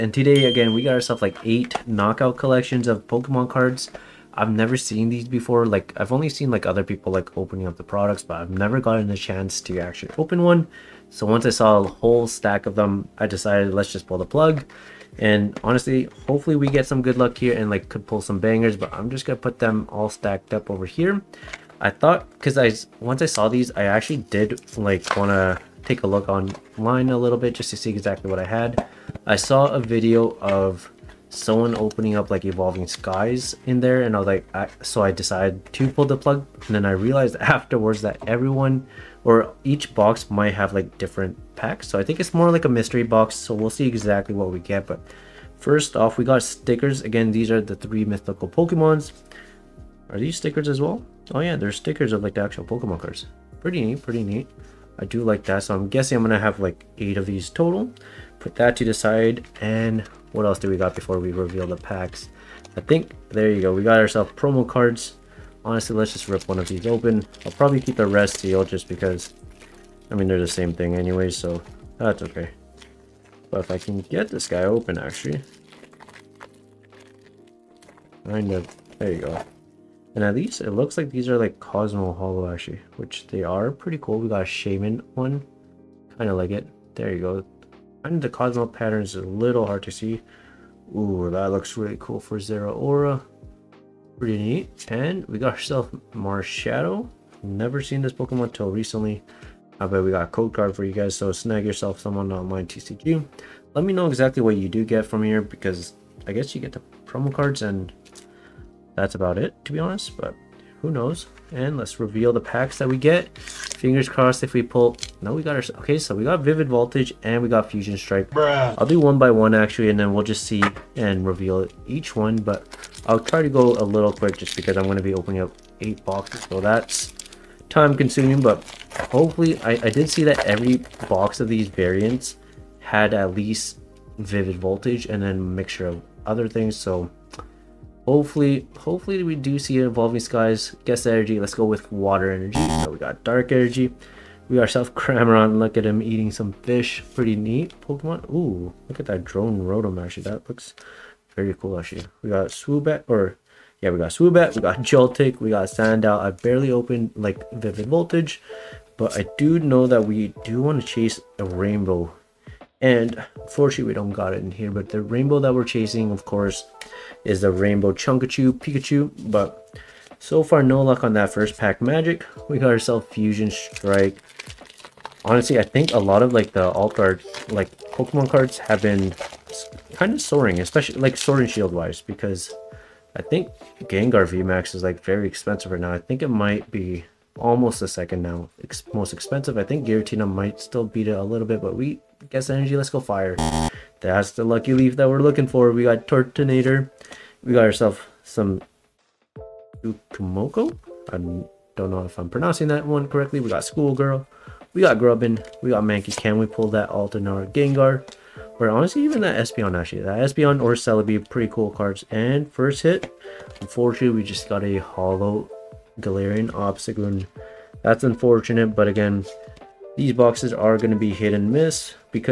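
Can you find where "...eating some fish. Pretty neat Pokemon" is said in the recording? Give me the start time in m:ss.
2:26.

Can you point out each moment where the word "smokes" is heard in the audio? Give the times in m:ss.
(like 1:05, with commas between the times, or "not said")
not said.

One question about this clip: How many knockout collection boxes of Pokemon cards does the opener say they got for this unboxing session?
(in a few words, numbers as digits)
8.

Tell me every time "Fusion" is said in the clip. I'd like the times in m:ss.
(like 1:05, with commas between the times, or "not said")
1:57, 2:53.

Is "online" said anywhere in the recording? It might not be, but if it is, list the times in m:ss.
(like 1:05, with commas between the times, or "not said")
0:26, 1:42.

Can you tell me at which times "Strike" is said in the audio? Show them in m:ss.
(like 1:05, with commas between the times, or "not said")
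1:57, 2:53.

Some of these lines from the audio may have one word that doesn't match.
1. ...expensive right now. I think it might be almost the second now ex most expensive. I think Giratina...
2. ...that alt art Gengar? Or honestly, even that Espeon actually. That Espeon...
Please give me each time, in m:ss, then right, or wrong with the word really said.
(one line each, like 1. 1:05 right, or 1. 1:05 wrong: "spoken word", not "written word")
1. 3:05 right
2. 3:26 right.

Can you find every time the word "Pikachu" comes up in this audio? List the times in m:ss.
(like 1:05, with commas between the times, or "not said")
2:48.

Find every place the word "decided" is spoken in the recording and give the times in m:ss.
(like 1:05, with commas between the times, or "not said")
0:13, 0:35.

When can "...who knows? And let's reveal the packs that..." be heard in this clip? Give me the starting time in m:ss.
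1:50.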